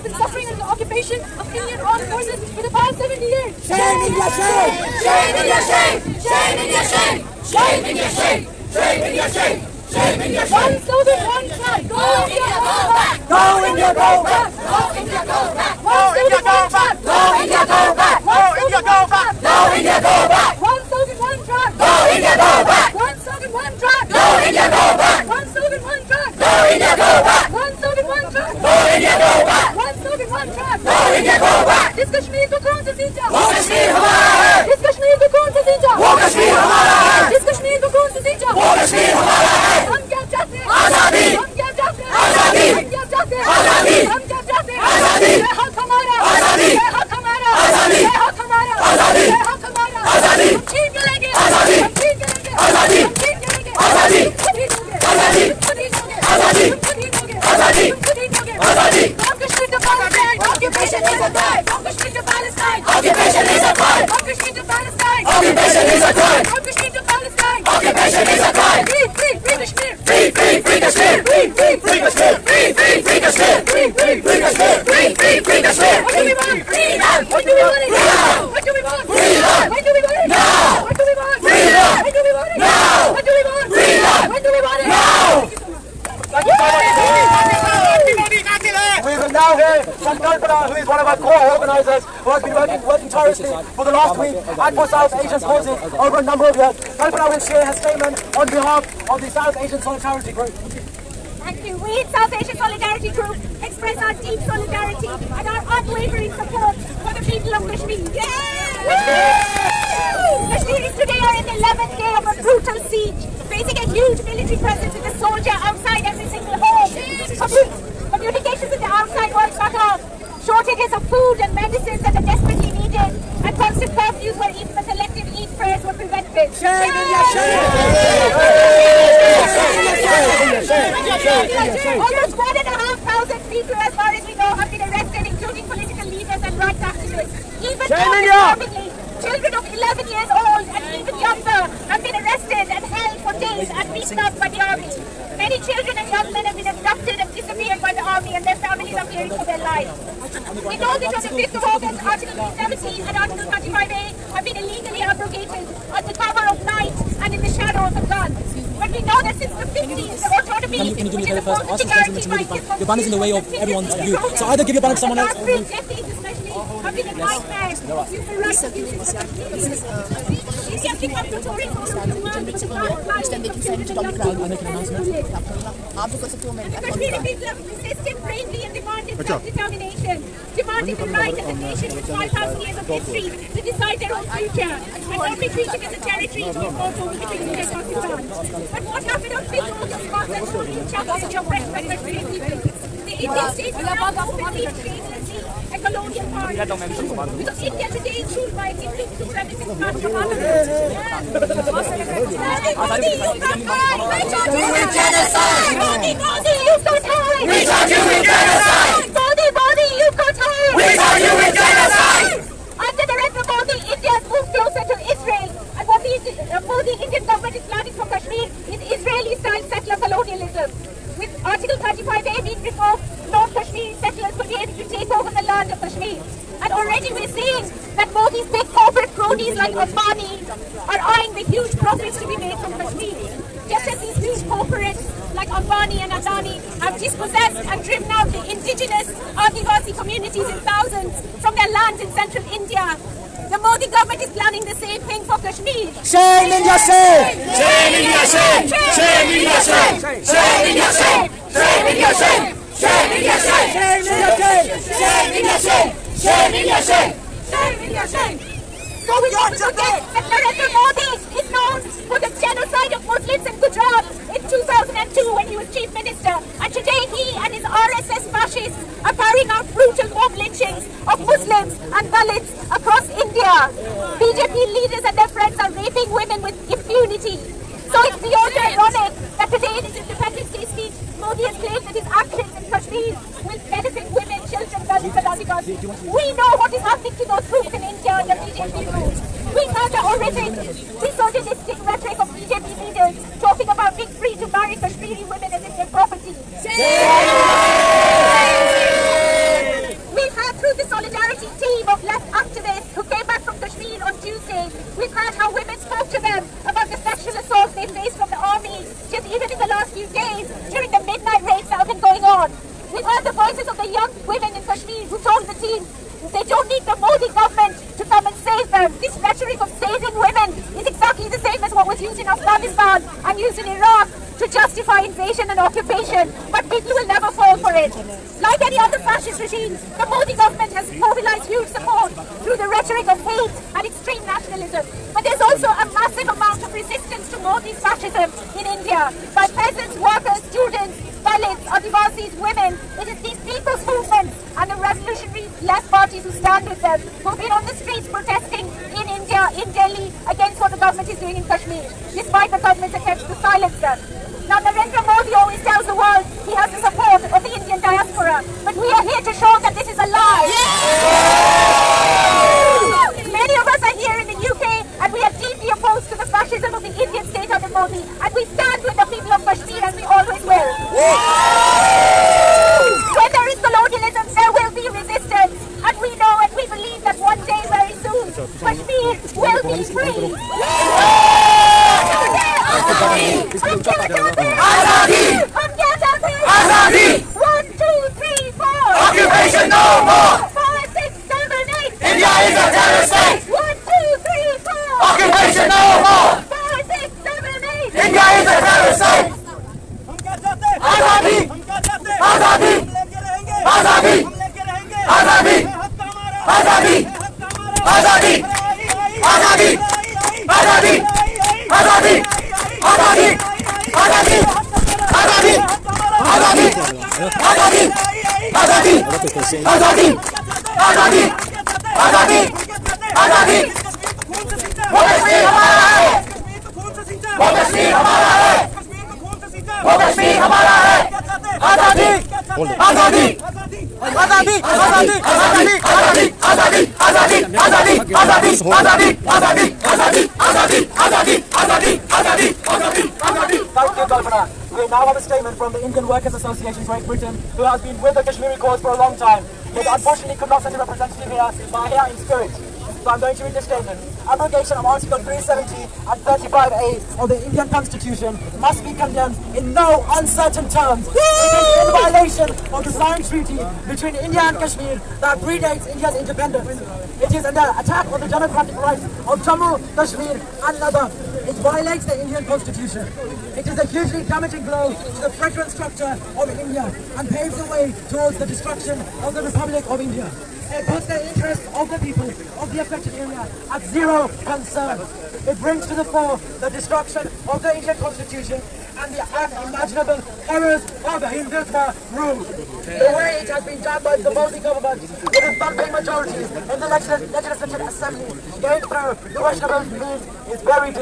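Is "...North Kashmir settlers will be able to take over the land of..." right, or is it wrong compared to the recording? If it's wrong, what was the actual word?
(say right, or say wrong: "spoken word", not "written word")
right.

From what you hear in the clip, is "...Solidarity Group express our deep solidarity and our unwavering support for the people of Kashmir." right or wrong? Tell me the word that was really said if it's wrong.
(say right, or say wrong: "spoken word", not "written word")
right.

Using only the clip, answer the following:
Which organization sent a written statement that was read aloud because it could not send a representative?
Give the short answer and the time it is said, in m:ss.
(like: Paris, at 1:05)
Indian Workers Association Great Britain, at 7:25.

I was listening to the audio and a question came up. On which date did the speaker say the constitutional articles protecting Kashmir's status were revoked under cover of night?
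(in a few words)
5th of August.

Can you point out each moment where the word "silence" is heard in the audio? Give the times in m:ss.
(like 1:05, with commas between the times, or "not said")
5:53.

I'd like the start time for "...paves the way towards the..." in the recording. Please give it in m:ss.
7:57.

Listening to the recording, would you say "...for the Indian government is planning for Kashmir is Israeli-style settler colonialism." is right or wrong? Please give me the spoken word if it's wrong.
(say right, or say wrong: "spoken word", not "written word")
right.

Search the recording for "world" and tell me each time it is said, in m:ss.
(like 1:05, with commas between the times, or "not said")
1:59, 5:55.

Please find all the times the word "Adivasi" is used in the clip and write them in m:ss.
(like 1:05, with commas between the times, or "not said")
3:59, 5:41.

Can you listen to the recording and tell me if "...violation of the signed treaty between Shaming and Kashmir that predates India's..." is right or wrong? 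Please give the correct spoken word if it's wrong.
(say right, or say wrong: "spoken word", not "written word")
wrong: "India", not "Shaming".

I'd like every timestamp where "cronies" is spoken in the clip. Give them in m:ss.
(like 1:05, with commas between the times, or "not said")
3:49.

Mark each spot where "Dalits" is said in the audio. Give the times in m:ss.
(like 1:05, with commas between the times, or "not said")
4:32, 5:41.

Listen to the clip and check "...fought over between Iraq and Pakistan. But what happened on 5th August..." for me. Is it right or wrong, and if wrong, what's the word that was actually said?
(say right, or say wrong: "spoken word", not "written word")
wrong: "India", not "Iraq".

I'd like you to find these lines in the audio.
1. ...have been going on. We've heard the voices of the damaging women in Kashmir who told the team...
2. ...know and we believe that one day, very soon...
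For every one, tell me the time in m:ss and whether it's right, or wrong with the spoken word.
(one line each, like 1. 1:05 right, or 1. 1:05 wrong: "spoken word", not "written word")
1. 5:11 wrong: "young", not "damaging"
2. 6:16 right.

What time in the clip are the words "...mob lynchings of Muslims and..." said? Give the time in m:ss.
4:30.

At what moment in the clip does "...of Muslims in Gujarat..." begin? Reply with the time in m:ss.
4:22.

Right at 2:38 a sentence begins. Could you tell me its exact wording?
But we know that since the 50s, the autonomy, can you, can you do me a favor first?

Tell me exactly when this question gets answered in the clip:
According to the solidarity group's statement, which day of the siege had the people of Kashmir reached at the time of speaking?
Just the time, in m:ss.
1:51.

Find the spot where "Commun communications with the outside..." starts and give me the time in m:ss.
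1:57.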